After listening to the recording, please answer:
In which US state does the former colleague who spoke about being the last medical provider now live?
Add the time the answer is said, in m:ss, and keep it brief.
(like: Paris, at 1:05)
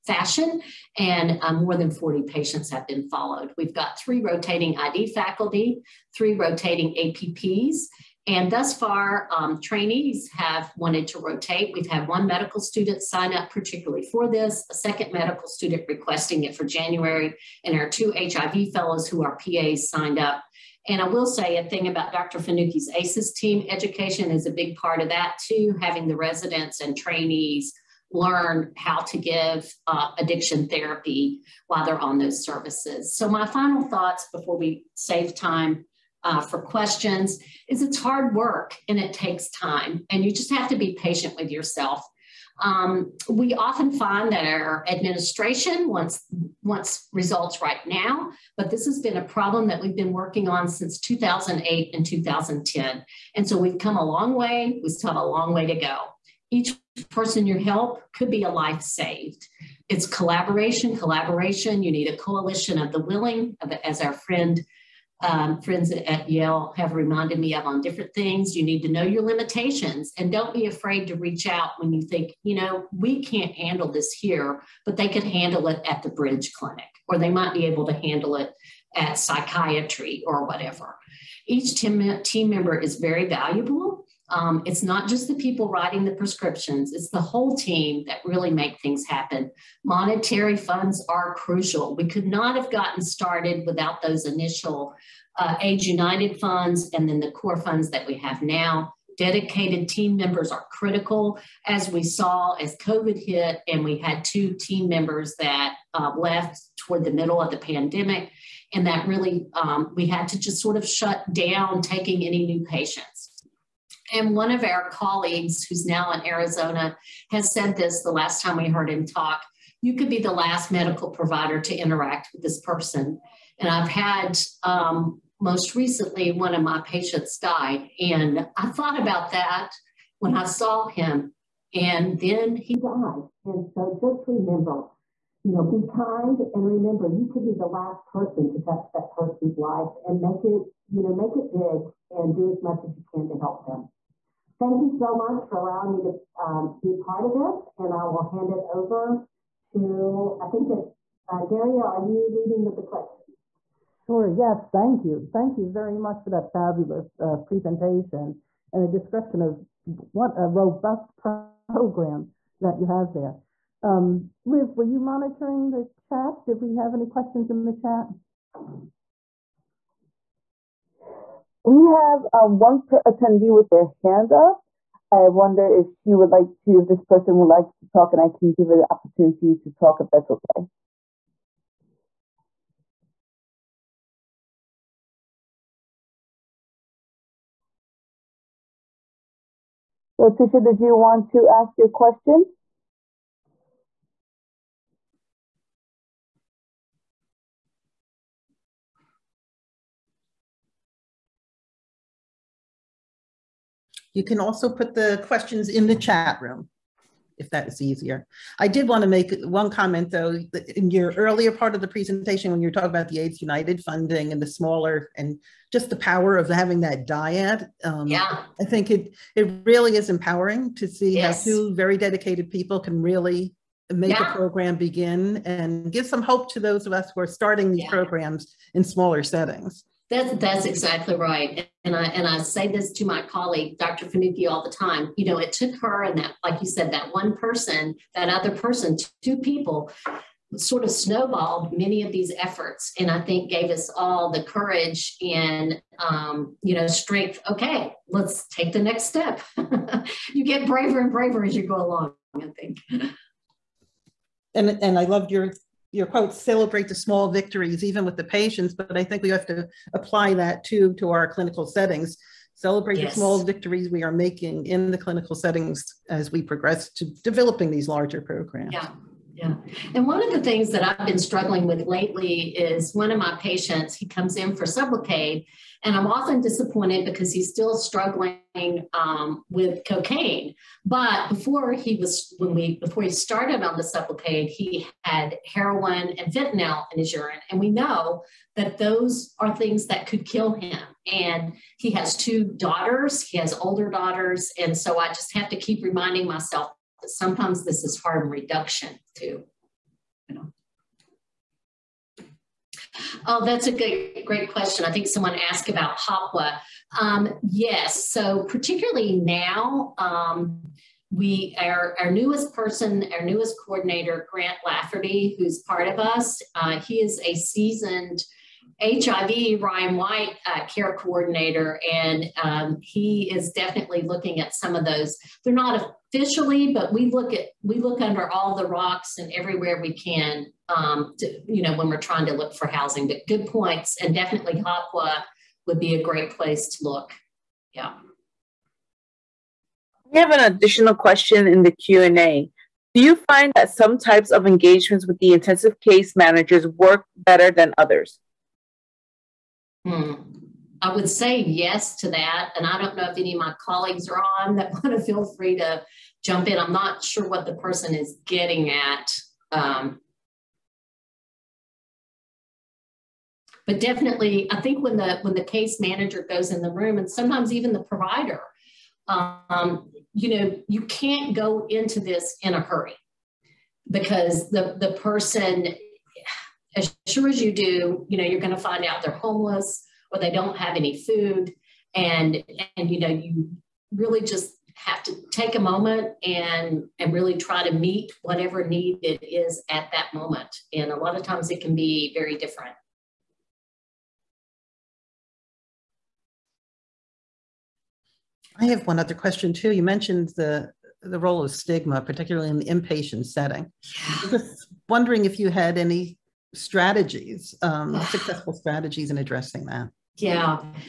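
Arizona, at 1:56.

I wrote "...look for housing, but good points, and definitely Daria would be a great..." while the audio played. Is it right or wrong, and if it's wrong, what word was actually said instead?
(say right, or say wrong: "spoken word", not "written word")
wrong: "HOPWA", not "Daria".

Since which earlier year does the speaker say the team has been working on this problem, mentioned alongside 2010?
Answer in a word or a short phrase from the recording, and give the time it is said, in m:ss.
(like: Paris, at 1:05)
2008, at 0:50.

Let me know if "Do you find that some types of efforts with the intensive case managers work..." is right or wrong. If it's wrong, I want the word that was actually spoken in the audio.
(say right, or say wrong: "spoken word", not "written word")
wrong: "engagements", not "efforts".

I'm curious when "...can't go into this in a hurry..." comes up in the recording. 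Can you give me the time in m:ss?
6:10.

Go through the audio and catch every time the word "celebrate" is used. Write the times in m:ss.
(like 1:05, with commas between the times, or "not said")
4:16, 4:22.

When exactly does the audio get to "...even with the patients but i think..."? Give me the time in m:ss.
4:17.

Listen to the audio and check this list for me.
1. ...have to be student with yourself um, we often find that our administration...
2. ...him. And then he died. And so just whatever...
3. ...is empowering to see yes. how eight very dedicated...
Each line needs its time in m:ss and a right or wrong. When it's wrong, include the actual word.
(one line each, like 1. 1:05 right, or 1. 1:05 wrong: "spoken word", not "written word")
1. 0:40 wrong: "patient", not "student"
2. 2:10 wrong: "remember", not "whatever"
3. 3:39 wrong: "two", not "eight".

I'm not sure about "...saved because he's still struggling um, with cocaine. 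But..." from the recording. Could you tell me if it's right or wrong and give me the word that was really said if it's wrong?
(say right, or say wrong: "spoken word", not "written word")
wrong: "disappointed", not "saved".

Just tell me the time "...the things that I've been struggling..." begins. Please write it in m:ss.
4:30.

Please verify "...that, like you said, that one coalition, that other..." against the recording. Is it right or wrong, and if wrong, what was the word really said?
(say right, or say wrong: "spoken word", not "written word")
wrong: "person", not "coalition".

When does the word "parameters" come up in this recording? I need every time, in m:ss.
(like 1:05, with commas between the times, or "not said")
not said.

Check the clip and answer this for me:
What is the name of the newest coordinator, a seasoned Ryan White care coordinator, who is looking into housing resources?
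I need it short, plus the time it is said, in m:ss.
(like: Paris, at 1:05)
Grant Lafferty, at 5:14.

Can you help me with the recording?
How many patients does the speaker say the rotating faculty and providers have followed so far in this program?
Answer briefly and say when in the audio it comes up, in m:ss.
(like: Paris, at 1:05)
more than 40, at 0:01.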